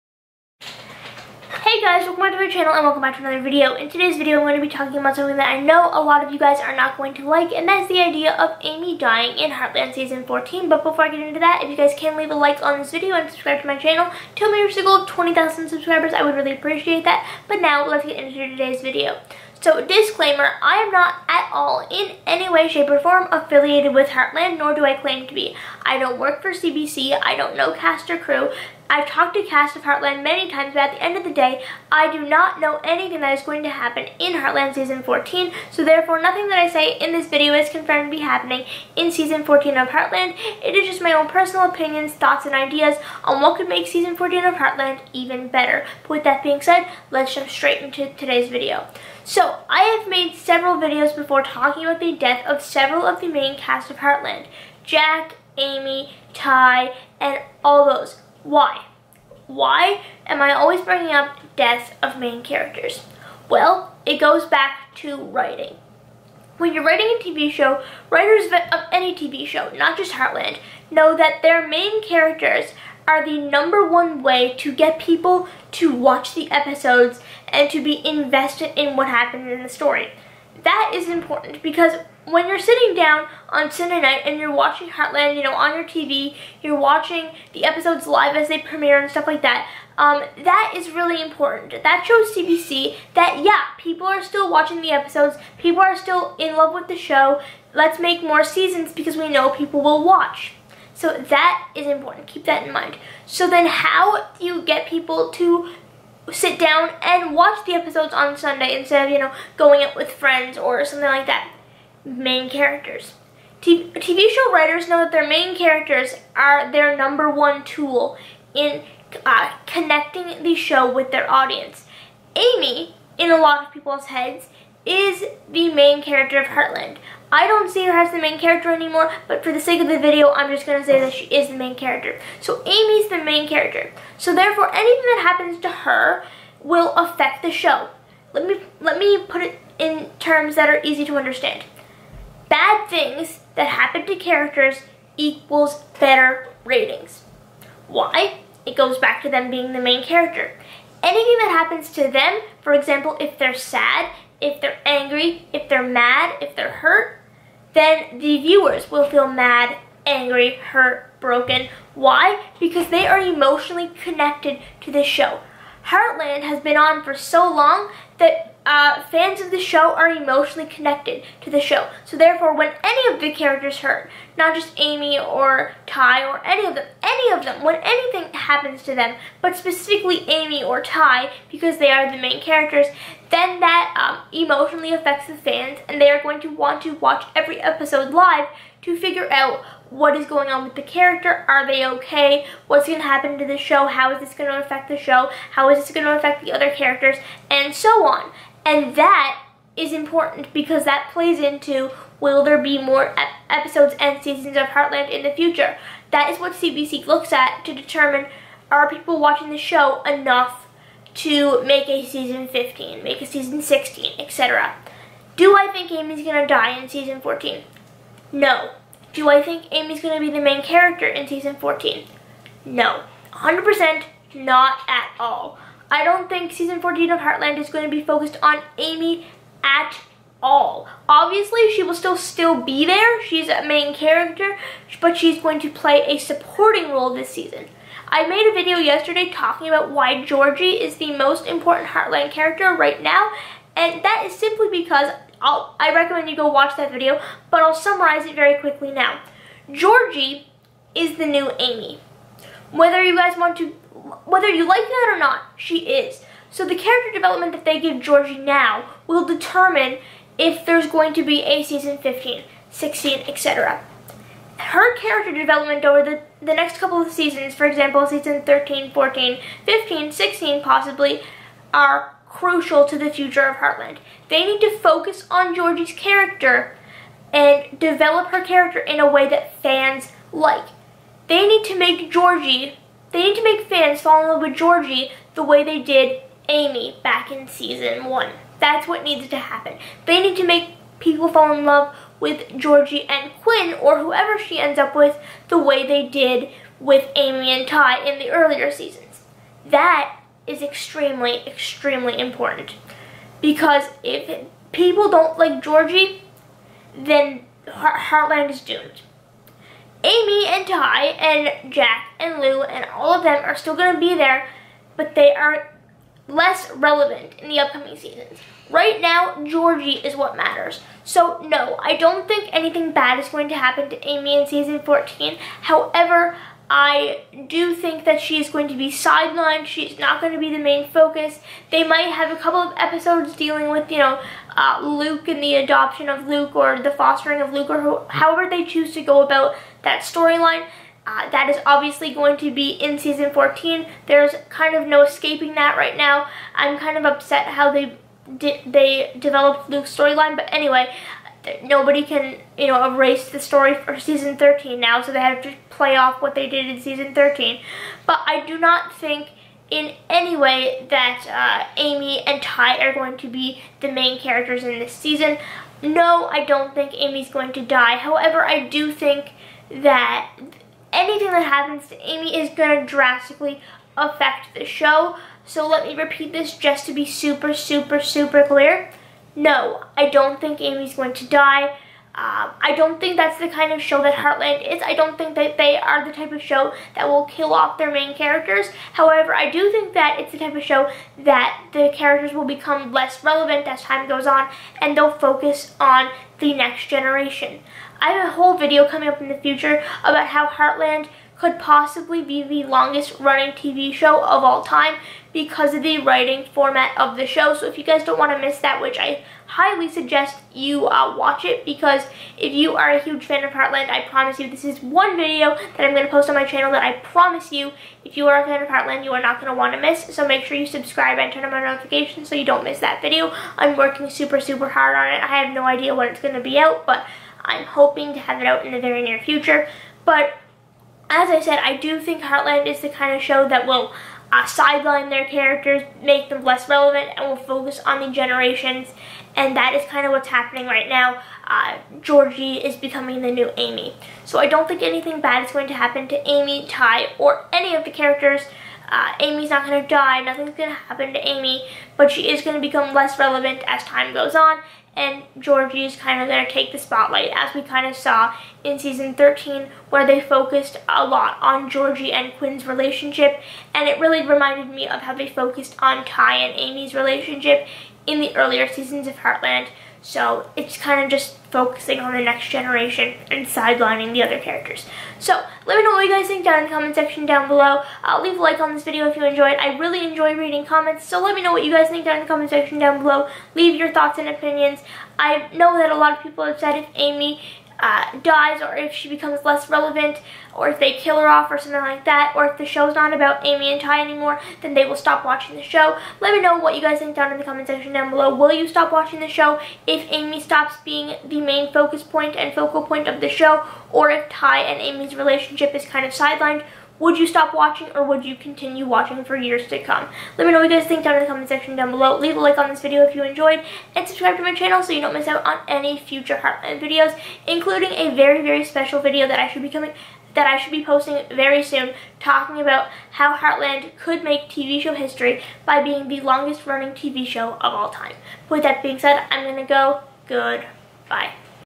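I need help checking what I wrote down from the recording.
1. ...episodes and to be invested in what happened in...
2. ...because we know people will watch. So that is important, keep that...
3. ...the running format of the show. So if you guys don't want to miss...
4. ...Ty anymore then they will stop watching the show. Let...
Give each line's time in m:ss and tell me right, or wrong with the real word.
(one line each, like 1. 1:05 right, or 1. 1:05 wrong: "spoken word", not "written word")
1. 1:16 right
2. 1:38 right
3. 6:45 wrong: "writing", not "running"
4. 8:13 right.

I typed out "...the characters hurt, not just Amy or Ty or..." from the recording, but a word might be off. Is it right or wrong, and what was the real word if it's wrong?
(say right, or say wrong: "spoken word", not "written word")
right.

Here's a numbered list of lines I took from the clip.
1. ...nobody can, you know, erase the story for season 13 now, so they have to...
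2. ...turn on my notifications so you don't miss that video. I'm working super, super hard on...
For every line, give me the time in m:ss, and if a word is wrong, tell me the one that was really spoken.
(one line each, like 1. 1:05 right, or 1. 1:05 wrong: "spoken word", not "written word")
1. 5:51 right
2. 7:01 right.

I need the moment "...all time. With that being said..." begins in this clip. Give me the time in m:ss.
8:47.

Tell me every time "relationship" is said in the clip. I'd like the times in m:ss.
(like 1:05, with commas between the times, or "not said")
7:42, 7:46, 8:25.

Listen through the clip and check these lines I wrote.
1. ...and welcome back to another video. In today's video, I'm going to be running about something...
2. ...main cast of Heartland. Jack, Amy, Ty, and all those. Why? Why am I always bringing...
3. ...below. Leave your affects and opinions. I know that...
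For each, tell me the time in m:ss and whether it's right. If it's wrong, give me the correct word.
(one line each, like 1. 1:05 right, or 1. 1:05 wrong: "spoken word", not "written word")
1. 0:02 wrong: "talking", not "running"
2. 0:53 right
3. 8:03 wrong: "thoughts", not "affects".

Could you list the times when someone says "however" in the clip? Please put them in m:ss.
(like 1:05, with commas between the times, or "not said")
5:25, 5:38, 6:07, 6:28.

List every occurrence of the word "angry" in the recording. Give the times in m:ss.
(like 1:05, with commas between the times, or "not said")
2:34, 2:40.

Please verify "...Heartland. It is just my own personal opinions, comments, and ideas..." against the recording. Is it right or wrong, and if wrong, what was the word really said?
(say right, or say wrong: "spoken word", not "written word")
wrong: "thoughts", not "comments".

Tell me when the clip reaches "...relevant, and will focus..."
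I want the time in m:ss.
7:16.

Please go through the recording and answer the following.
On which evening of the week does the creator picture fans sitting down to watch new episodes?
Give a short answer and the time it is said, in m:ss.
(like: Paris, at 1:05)
Sunday night, at 1:23.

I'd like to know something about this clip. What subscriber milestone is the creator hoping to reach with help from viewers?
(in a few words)
20,000.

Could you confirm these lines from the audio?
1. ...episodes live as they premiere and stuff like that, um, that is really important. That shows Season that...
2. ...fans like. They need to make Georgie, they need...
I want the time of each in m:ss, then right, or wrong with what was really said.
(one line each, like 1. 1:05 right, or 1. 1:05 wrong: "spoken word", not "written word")
1. 1:27 wrong: "CBC", not "Season"
2. 4:39 right.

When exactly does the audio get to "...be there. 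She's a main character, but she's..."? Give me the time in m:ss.
3:52.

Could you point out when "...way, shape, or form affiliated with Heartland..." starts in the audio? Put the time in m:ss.
0:22.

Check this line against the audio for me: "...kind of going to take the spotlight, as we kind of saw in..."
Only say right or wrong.
right.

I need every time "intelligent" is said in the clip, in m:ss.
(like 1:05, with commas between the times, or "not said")
not said.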